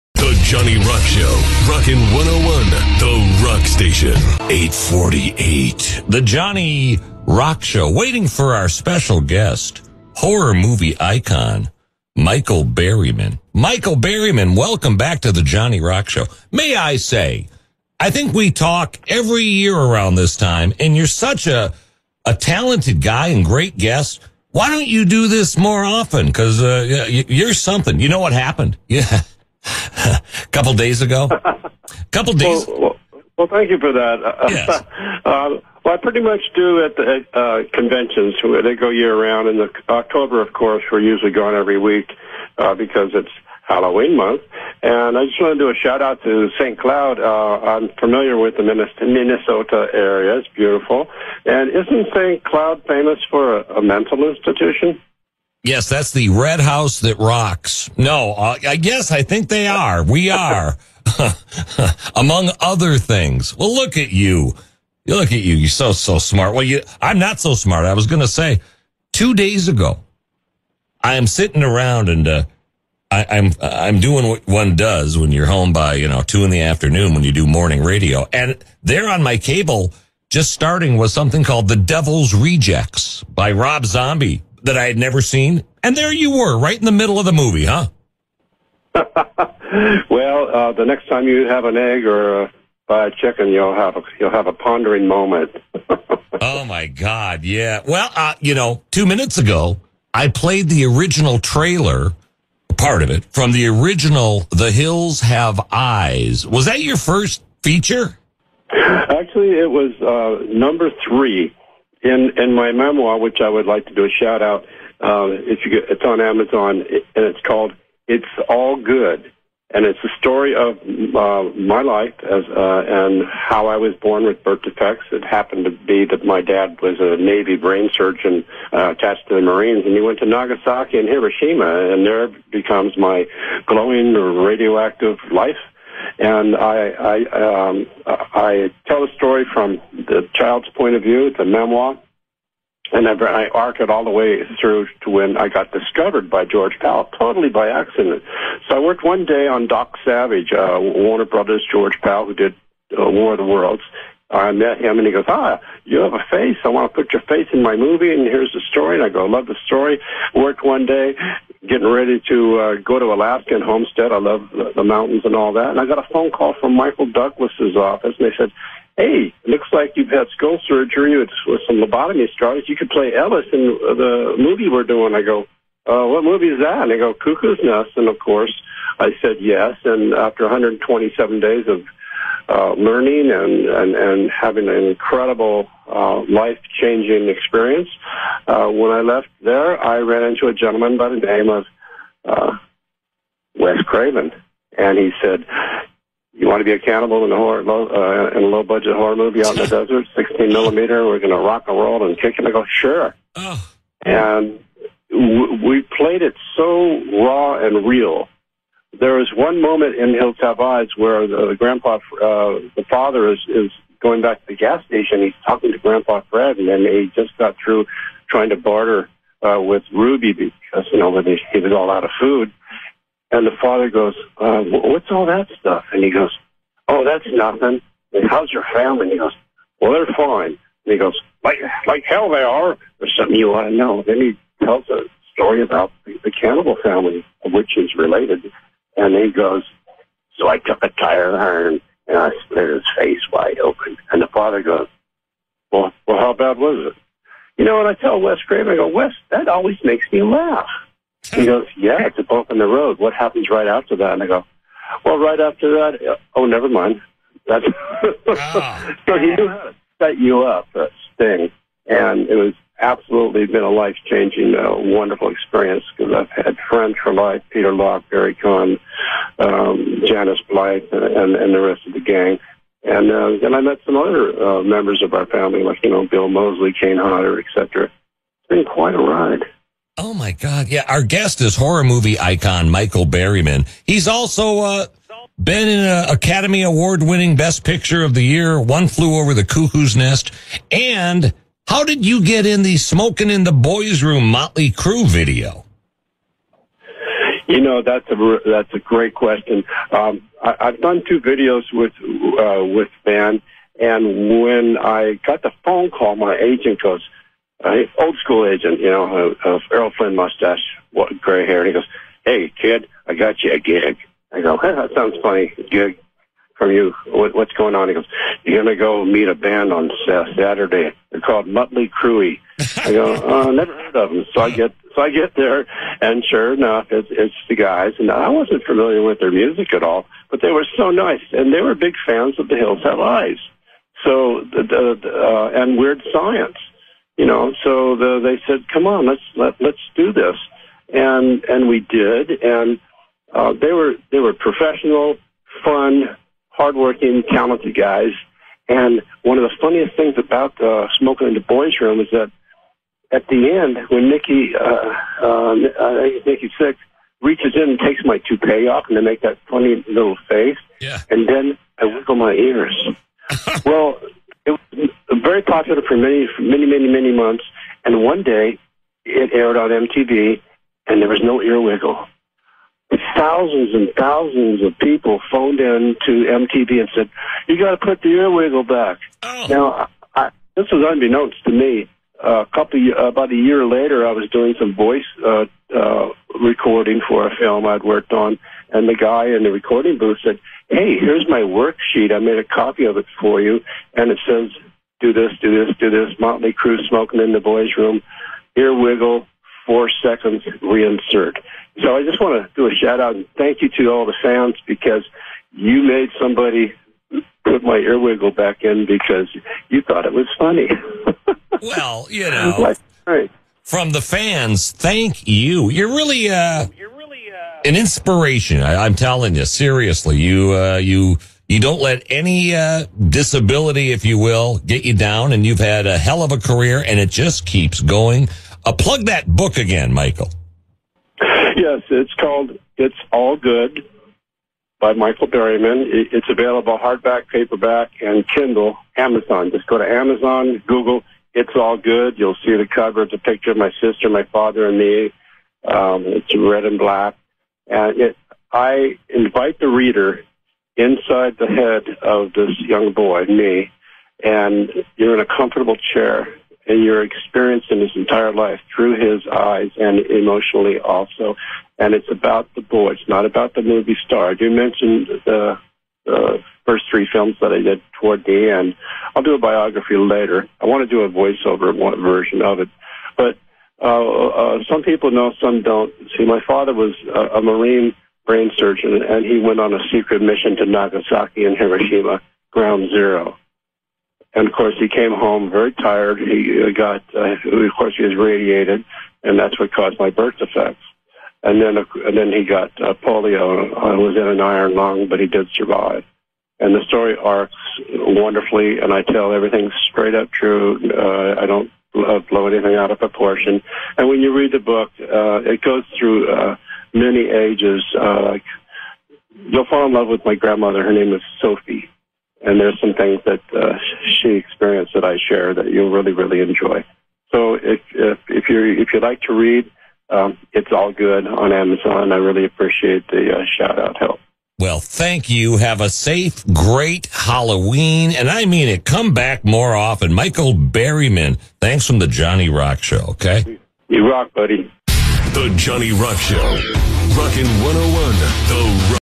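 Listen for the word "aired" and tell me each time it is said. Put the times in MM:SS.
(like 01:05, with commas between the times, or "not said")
06:09.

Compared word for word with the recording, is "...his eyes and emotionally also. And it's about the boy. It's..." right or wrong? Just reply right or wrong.
right.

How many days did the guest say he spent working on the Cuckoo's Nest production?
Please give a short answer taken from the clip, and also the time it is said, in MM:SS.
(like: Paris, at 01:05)
127, at 03:00.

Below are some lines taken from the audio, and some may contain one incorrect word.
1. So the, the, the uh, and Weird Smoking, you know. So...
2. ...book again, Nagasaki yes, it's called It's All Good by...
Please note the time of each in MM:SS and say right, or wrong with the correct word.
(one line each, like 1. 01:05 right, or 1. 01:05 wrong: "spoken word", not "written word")
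1. 05:34 wrong: "Science", not "Smoking"
2. 07:09 wrong: "Michael", not "Nagasaki".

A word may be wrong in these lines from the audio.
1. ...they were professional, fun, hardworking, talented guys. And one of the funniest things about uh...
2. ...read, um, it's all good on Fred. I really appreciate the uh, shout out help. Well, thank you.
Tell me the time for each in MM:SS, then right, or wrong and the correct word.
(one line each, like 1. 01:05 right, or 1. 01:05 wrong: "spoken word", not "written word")
1. 05:44 right
2. 08:39 wrong: "Amazon", not "Fred".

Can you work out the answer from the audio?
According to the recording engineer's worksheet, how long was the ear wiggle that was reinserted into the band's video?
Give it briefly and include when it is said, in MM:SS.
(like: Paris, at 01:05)
4 seconds, at 06:39.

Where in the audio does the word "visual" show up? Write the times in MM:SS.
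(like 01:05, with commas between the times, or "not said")
not said.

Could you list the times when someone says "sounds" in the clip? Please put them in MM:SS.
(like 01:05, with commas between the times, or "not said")
05:14, 06:44.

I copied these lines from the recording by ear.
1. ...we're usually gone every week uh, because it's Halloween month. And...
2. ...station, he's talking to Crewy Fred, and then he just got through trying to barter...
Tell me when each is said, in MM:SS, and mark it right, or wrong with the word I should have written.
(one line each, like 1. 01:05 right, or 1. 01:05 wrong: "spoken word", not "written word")
1. 00:40 right
2. 03:34 wrong: "Grandpa", not "Crewy".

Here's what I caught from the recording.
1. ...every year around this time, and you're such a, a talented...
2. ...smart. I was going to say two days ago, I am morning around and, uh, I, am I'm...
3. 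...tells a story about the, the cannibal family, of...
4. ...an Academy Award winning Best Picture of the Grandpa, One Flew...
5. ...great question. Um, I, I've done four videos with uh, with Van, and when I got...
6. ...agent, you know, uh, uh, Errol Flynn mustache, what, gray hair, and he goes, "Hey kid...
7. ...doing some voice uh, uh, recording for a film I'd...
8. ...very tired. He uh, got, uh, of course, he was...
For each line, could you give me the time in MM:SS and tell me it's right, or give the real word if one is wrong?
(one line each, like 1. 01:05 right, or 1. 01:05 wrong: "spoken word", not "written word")
1. 00:19 right
2. 01:07 wrong: "sitting", not "morning"
3. 03:54 right
4. 04:45 wrong: "Year", not "Grandpa"
5. 04:58 wrong: "two", not "four"
6. 05:08 right
7. 06:24 right
8. 08:05 right.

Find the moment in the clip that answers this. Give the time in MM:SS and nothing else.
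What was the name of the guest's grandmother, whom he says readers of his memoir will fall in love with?
08:31.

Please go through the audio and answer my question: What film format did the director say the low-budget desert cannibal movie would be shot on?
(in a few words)
16 millimeter.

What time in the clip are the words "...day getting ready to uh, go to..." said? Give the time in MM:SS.
02:40.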